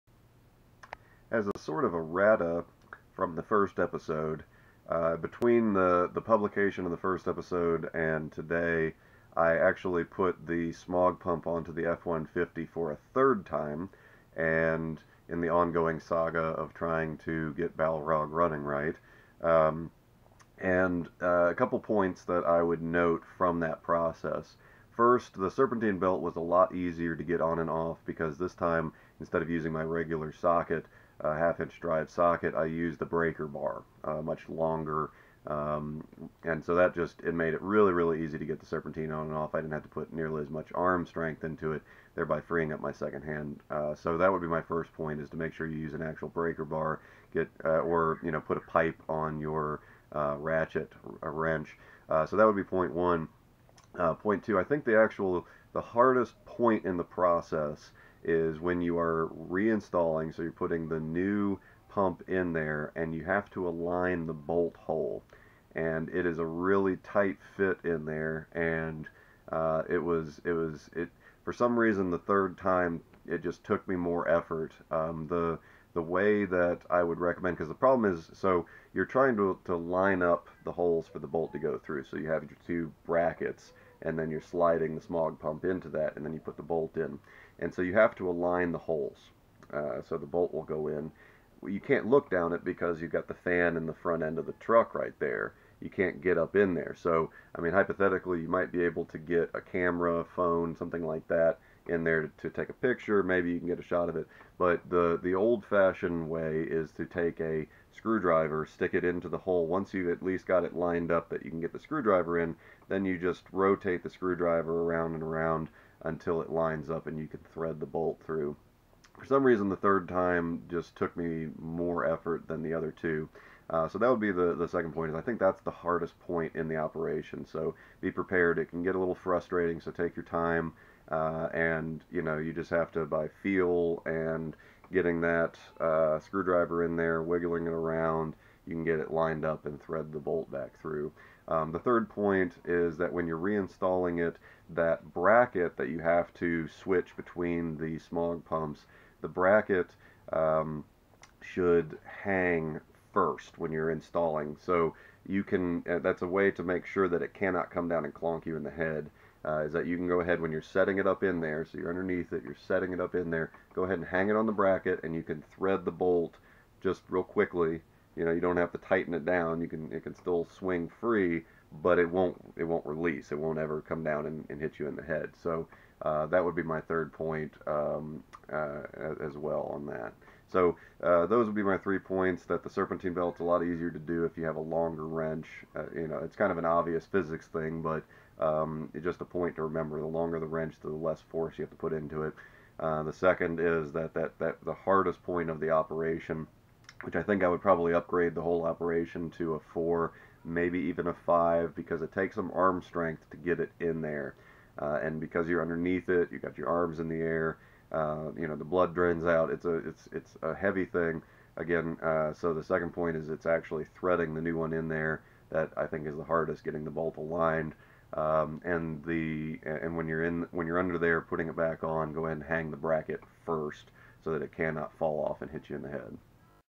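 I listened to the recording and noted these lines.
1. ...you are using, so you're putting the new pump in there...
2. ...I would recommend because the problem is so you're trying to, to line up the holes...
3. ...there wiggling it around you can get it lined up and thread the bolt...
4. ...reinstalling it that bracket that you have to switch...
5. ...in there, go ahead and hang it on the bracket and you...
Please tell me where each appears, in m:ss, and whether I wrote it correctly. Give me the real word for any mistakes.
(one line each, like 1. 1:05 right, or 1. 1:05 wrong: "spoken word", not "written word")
1. 0:58 wrong: "reinstalling", not "using"
2. 1:16 right
3. 2:16 right
4. 2:23 right
5. 2:43 right.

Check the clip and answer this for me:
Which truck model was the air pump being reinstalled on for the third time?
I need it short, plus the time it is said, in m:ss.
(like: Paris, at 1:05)
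F-150, at 0:11.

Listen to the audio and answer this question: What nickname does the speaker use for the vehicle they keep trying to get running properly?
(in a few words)
Balrog.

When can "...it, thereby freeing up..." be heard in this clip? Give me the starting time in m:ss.
0:41.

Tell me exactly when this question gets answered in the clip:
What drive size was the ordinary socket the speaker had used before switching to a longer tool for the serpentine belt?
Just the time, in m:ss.
0:31.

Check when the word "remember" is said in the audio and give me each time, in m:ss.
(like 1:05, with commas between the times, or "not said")
3:09.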